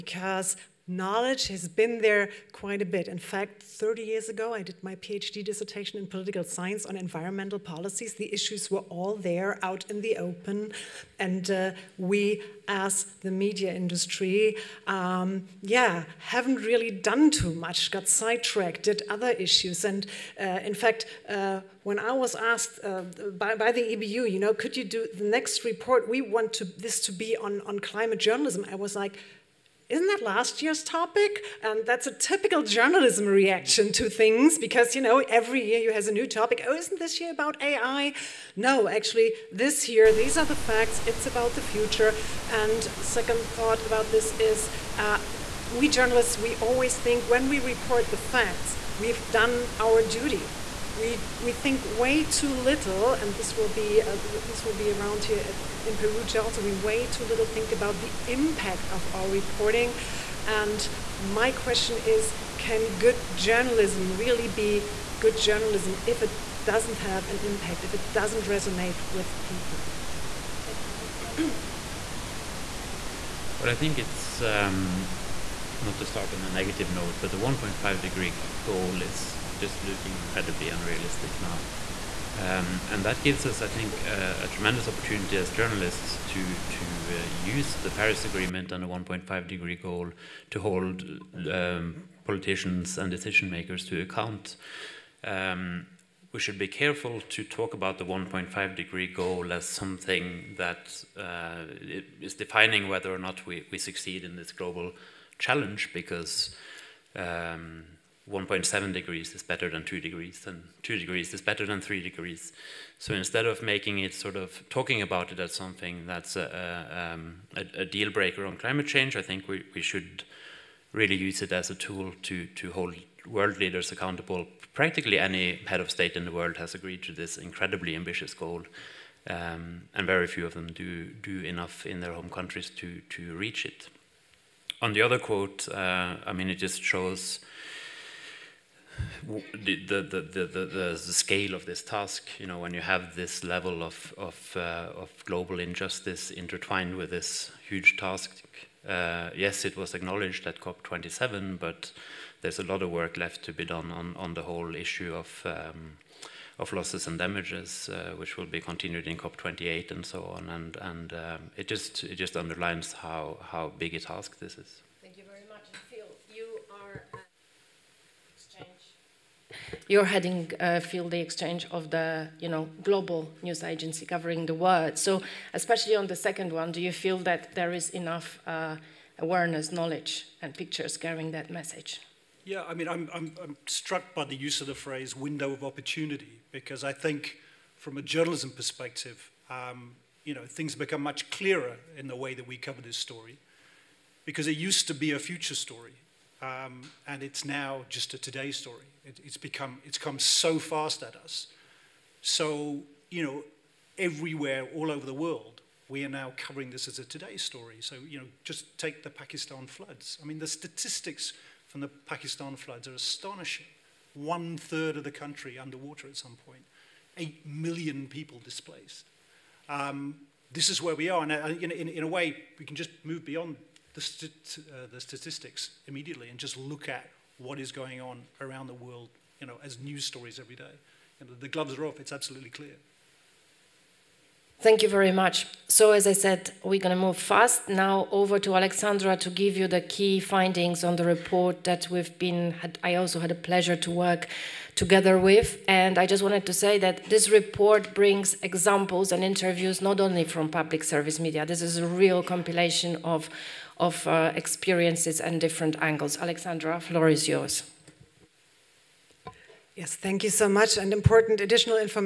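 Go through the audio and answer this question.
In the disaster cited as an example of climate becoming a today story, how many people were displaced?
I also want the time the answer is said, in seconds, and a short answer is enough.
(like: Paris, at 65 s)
8 million, at 217 s.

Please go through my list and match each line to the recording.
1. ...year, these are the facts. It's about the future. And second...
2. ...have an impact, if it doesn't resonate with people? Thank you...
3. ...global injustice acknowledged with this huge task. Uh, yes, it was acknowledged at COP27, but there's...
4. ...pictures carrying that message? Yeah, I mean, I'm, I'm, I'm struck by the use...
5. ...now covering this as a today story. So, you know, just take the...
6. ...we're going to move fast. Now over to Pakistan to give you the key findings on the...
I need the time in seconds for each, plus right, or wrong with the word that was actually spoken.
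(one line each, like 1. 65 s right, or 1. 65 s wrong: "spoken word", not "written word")
1. 39 s right
2. 66 s right
3. 145 s wrong: "intertwined", not "acknowledged"
4. 180 s right
5. 206 s right
6. 236 s wrong: "Alexandra", not "Pakistan".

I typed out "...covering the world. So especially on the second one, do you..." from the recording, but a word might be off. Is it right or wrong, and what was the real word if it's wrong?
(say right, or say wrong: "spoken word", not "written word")
right.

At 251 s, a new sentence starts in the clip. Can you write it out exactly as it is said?
This is a real compilation of, of uh, experiences and different angles.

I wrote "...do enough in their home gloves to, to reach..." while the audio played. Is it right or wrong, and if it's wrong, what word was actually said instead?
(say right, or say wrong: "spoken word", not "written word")
wrong: "countries", not "gloves".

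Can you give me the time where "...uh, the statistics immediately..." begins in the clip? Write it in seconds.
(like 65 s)
224 s.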